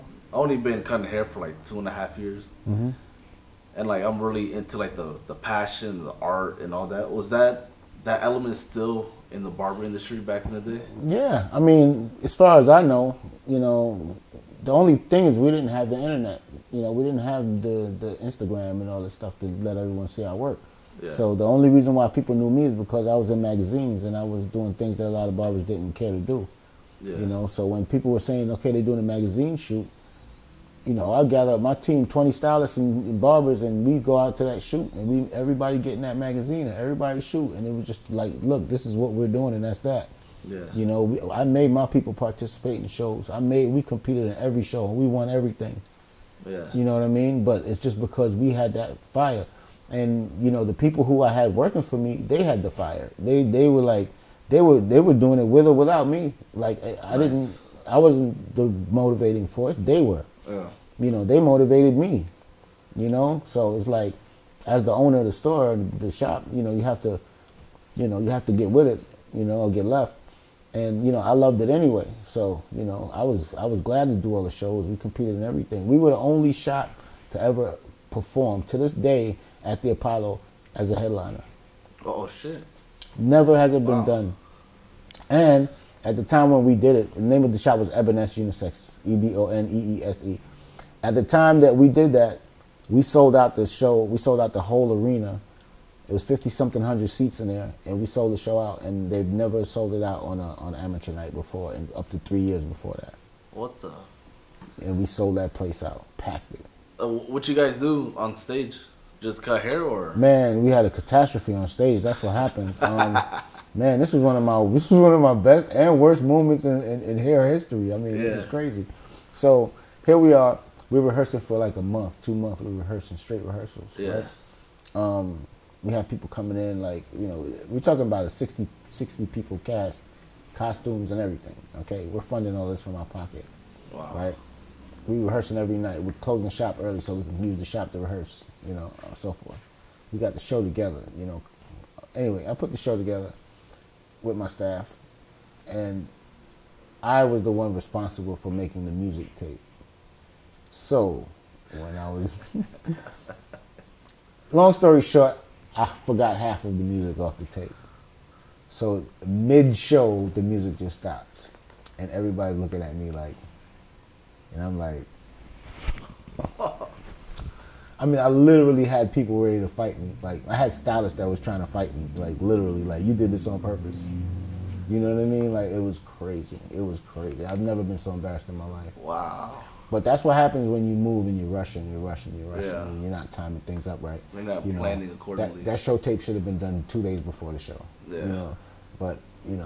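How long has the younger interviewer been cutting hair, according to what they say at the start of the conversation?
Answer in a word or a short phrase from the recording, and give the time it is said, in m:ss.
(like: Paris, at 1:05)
2 and a half years, at 0:01.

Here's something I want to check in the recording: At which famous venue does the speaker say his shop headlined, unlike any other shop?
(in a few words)
Apollo.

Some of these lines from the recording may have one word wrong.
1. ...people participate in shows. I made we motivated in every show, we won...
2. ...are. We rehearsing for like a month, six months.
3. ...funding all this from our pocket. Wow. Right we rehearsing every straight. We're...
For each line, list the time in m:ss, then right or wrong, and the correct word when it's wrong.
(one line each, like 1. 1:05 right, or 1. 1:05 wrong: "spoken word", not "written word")
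1. 0:41 wrong: "competed", not "motivated"
2. 2:00 wrong: "two", not "six"
3. 2:12 wrong: "night", not "straight".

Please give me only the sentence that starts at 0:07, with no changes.
Was that that element still in the barber industry back in the day?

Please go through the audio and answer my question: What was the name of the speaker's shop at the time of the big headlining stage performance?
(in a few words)
Eboness Unisex.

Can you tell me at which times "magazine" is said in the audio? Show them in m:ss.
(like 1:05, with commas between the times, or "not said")
0:23, 0:29, 0:36.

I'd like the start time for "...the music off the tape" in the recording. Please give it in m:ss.
2:36.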